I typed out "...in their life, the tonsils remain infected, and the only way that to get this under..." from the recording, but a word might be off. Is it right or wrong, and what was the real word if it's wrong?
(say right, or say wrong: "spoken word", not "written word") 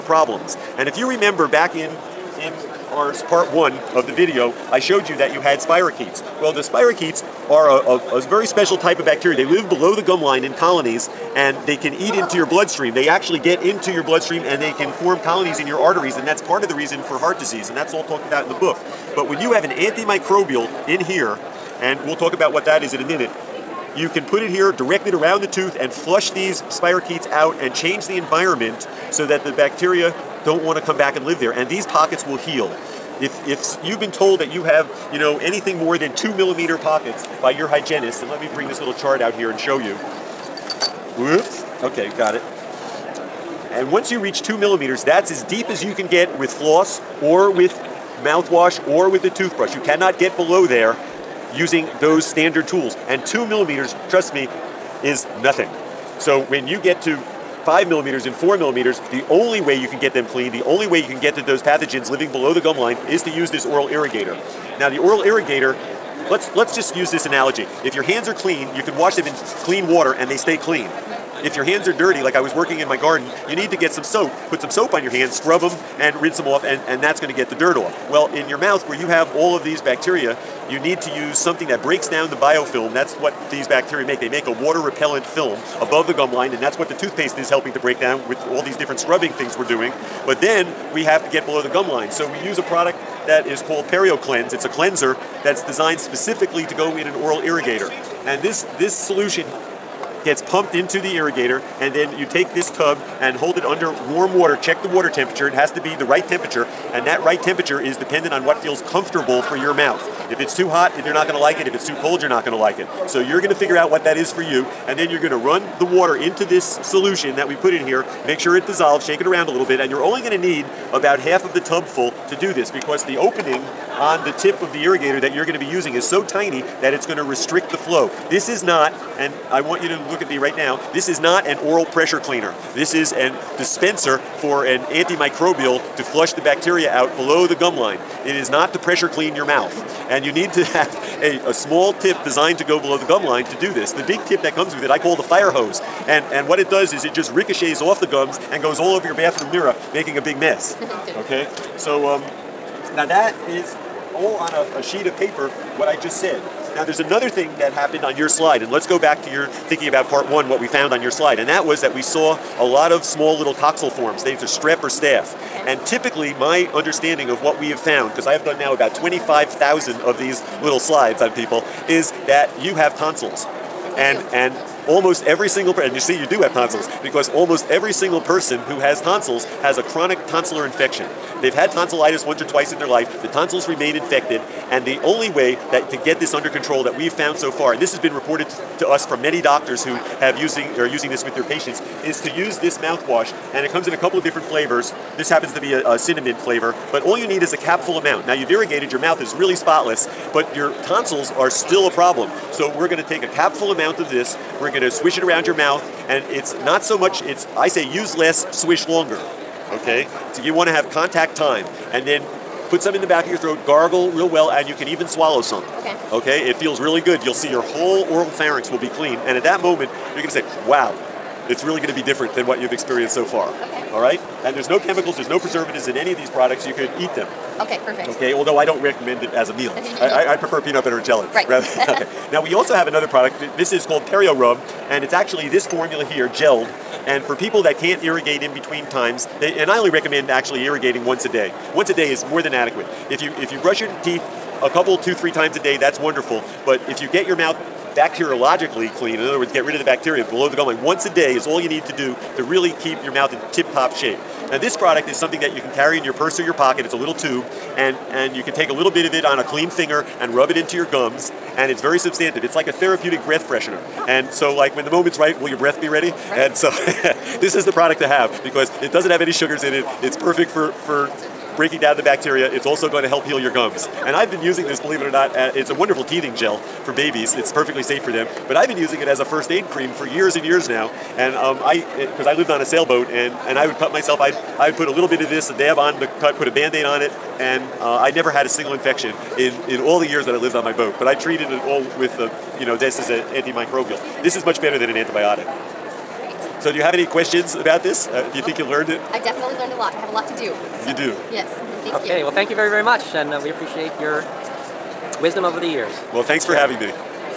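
right.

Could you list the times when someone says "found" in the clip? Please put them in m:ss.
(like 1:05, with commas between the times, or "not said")
2:40, 2:47, 3:07.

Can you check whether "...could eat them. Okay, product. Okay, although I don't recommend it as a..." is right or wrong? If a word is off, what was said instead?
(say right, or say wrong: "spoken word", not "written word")
wrong: "perfect", not "product".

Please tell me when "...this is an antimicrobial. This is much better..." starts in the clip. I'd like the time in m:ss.
4:52.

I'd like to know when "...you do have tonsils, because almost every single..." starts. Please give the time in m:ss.
2:56.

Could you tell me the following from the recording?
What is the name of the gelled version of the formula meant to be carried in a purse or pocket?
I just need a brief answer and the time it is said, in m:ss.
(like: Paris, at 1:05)
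Perio Rub, at 3:54.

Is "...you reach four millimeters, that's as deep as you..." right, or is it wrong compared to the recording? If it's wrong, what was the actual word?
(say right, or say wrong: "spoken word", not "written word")
wrong: "two", not "four".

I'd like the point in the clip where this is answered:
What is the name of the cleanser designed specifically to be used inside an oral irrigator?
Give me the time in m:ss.
1:33.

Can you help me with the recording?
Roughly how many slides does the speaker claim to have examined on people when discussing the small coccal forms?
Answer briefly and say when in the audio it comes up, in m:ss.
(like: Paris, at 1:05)
25,000, at 2:48.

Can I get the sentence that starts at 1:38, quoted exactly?
And this, this solution gets pumped into the irrigator and then you take this tub and hold it under warm water.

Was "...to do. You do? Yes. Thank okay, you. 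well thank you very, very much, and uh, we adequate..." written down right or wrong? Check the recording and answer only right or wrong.
wrong.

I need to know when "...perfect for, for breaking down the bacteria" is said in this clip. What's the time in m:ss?
4:30.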